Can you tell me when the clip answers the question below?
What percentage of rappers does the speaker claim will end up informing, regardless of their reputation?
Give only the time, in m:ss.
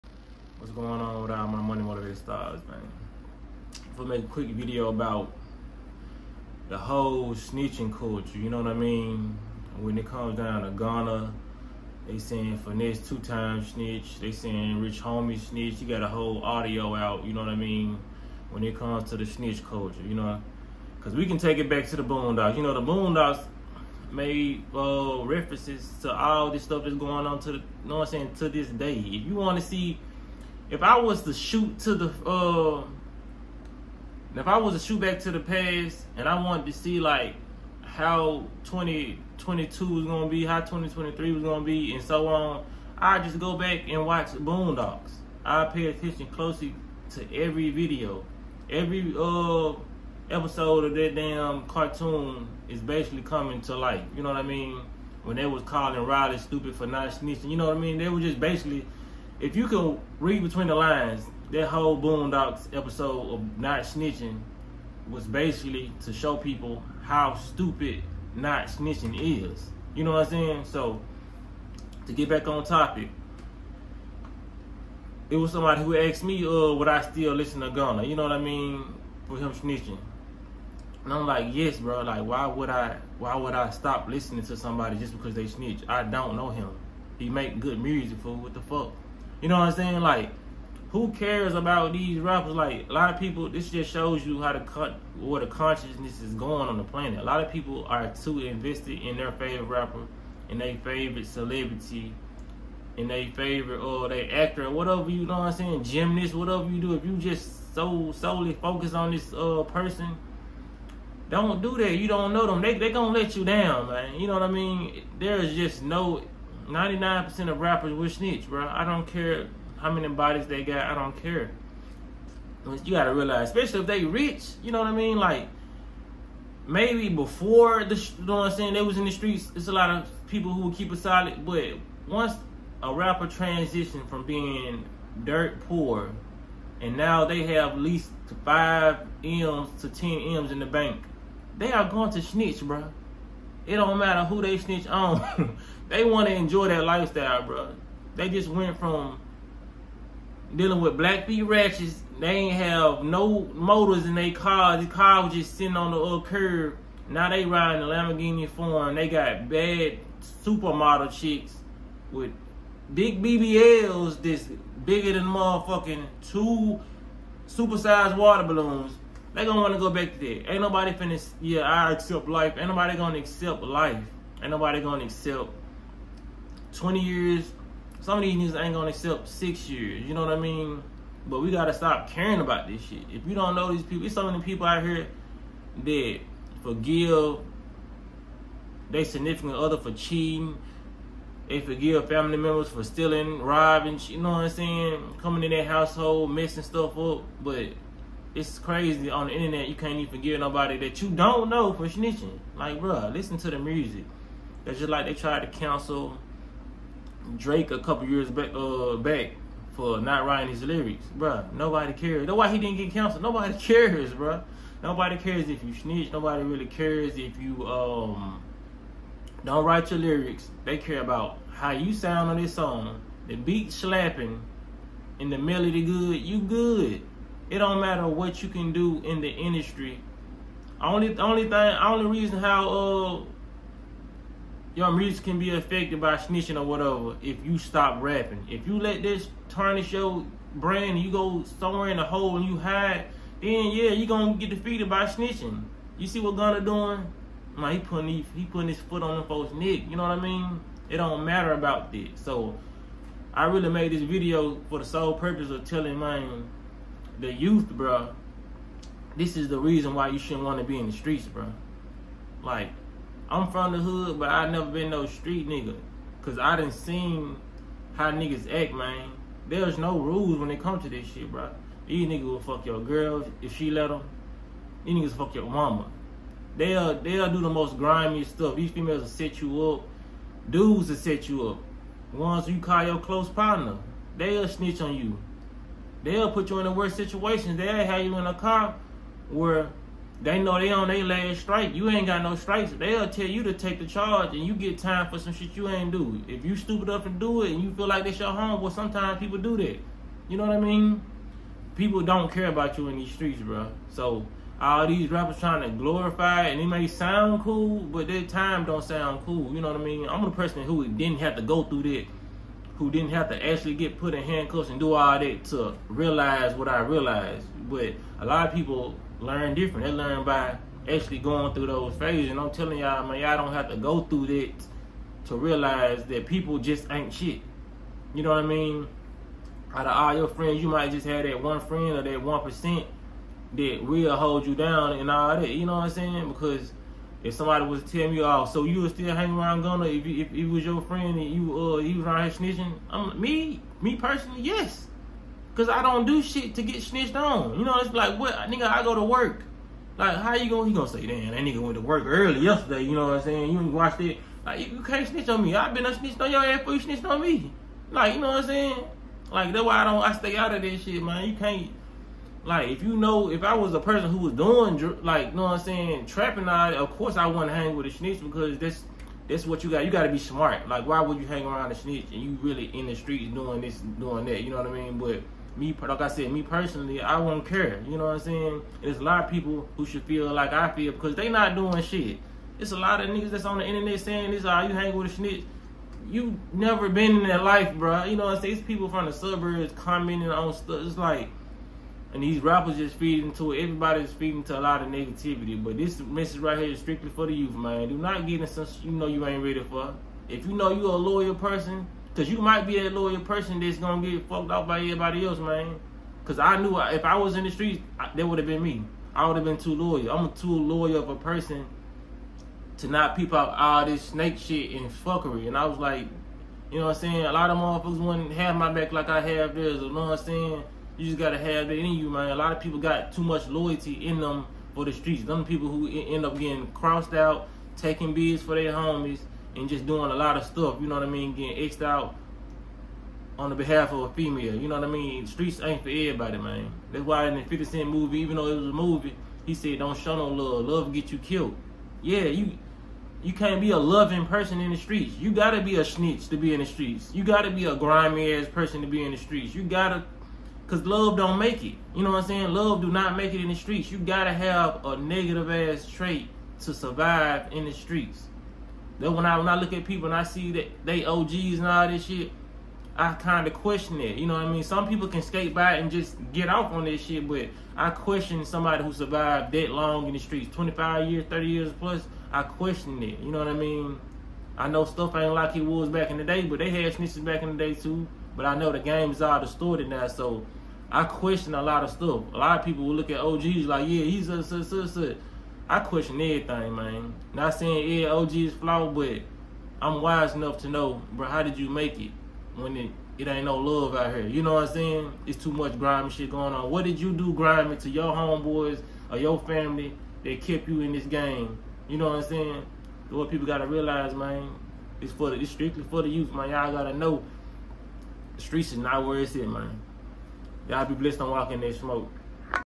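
1:56.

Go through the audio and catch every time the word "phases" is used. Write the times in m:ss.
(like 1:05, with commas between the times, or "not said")
5:21.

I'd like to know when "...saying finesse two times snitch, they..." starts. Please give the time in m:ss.
0:12.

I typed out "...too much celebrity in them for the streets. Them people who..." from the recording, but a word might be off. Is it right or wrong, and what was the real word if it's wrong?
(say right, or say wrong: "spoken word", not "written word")
wrong: "loyalty", not "celebrity".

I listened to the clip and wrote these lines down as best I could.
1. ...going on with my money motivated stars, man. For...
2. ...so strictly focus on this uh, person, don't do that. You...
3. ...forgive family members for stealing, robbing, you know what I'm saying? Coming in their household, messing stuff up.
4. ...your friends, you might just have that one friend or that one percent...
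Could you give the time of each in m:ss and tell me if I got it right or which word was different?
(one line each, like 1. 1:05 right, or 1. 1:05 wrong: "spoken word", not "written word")
1. 0:00 right
2. 1:47 wrong: "solely", not "strictly"
3. 3:11 right
4. 5:30 right.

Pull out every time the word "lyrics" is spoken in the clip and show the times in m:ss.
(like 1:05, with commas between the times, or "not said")
3:30, 3:39.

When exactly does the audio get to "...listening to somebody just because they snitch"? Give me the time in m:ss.
1:24.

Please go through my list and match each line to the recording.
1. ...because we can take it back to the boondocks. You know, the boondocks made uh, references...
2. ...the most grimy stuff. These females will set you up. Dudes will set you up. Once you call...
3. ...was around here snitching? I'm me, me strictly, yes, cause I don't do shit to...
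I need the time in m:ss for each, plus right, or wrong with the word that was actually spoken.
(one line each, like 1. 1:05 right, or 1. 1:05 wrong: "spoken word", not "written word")
1. 0:20 right
2. 4:37 right
3. 5:41 wrong: "personally", not "strictly".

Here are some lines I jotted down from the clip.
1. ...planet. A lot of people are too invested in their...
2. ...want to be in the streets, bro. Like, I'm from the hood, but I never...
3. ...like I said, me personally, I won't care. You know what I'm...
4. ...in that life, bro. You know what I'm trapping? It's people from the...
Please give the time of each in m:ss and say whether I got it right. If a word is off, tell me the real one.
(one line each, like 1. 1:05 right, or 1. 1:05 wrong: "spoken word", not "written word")
1. 1:36 right
2. 4:20 right
3. 6:15 right
4. 6:27 wrong: "saying", not "trapping".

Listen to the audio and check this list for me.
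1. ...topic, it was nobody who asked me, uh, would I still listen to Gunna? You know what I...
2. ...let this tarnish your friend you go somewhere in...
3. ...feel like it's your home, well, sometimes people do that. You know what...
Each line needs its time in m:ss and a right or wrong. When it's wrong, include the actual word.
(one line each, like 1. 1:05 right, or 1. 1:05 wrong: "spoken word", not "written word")
1. 1:12 wrong: "somebody", not "nobody"
2. 3:58 wrong: "brand", not "friend"
3. 4:57 right.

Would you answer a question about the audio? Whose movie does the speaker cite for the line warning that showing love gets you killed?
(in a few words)
50 Cent.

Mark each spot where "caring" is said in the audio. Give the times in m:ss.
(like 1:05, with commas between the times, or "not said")
3:02.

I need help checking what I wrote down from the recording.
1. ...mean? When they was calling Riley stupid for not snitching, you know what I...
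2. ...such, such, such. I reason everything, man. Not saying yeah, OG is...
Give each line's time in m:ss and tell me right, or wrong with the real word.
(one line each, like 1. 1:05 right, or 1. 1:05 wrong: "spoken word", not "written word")
1. 0:54 right
2. 8:04 wrong: "question", not "reason".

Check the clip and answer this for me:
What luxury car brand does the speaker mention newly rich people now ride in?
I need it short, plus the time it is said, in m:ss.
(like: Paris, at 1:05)
Lamborghini, at 2:37.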